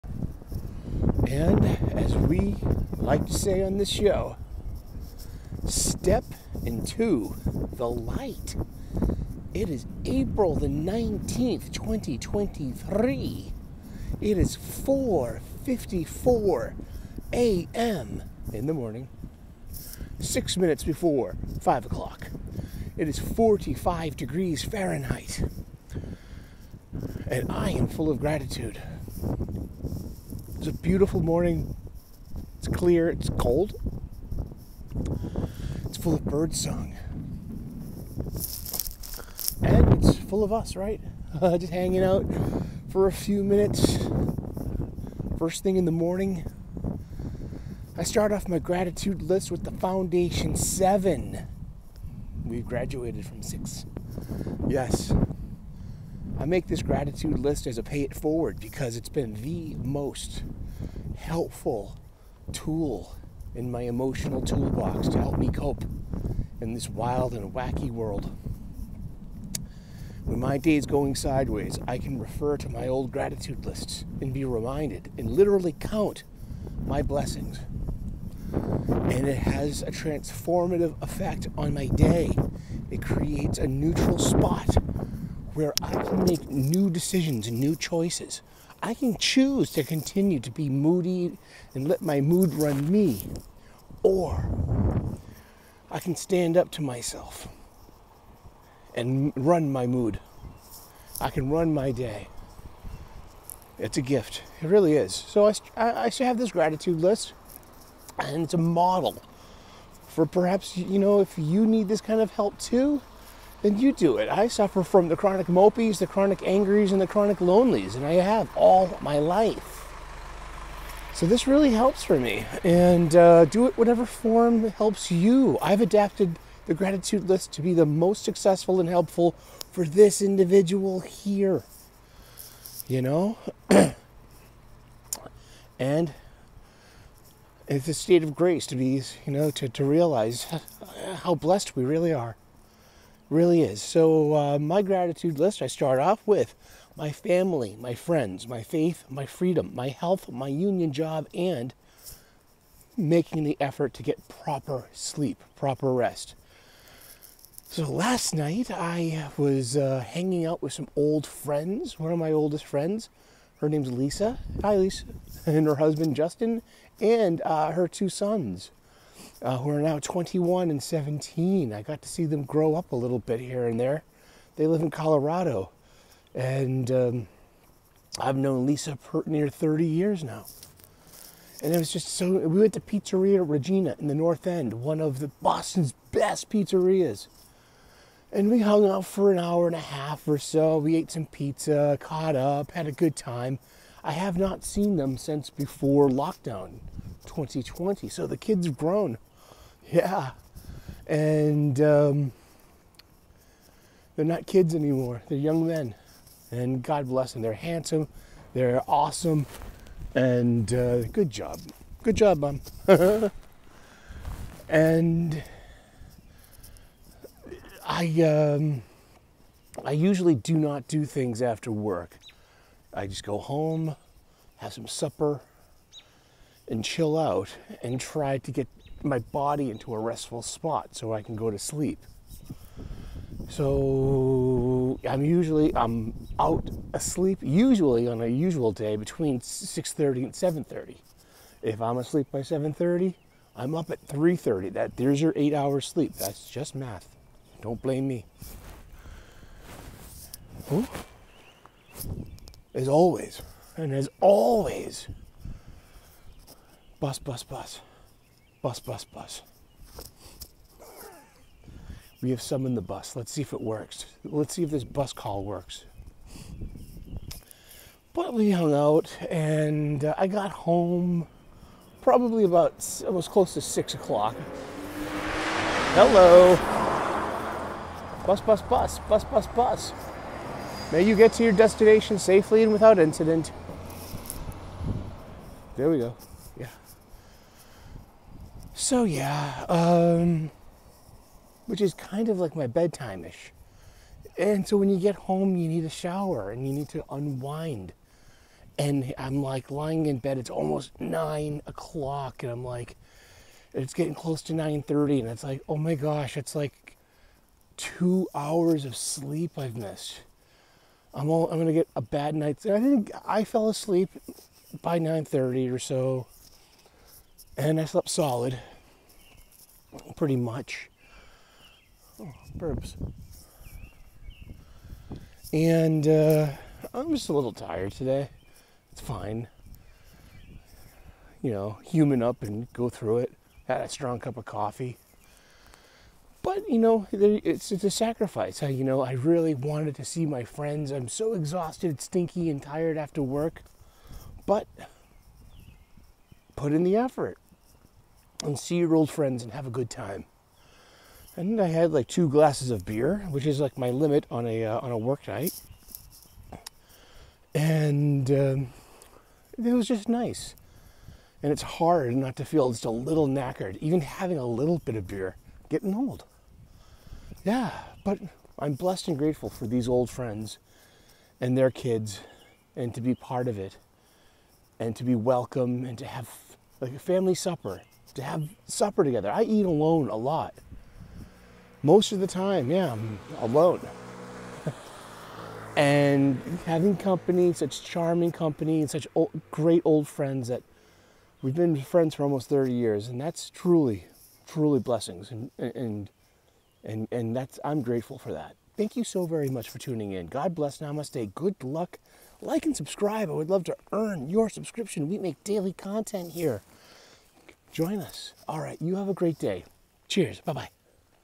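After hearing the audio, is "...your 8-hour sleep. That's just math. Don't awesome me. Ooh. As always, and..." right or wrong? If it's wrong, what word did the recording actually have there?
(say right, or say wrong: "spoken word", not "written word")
wrong: "blame", not "awesome".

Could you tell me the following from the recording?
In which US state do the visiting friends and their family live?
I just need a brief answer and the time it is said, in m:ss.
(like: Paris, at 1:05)
Colorado, at 2:54.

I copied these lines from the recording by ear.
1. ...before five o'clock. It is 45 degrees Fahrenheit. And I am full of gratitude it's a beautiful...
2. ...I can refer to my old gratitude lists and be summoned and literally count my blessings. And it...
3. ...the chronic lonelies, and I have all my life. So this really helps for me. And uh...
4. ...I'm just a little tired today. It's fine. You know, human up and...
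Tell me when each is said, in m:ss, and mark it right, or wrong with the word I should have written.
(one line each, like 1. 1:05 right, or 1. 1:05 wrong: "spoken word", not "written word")
1. 0:20 right
2. 1:11 wrong: "reminded", not "summoned"
3. 1:56 right
4. 5:26 right.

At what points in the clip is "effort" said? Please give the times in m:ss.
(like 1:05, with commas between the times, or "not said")
2:33, 5:46.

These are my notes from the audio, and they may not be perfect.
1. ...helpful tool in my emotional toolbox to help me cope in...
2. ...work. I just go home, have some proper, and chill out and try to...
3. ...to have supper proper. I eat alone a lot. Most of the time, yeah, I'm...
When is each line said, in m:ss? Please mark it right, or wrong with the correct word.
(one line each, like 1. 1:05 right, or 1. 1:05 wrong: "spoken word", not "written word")
1. 1:01 right
2. 3:41 wrong: "supper", not "proper"
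3. 6:18 wrong: "together", not "proper".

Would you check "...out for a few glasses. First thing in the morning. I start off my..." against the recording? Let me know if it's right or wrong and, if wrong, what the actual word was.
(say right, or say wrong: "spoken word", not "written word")
wrong: "minutes", not "glasses".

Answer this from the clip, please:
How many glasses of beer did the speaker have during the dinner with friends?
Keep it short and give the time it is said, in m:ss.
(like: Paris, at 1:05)
2, at 5:52.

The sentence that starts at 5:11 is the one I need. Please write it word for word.
I'm all, I'm gonna get a bad night's.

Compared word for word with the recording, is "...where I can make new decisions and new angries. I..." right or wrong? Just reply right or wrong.
wrong.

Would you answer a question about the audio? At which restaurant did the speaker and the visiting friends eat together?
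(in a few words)
Pizzeria Regina.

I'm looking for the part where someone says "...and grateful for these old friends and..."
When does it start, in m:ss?
6:09.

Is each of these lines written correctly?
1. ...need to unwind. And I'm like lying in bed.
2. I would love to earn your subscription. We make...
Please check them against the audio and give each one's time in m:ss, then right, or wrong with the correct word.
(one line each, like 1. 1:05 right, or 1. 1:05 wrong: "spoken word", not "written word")
1. 4:56 right
2. 6:43 right.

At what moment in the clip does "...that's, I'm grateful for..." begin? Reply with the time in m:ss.
6:37.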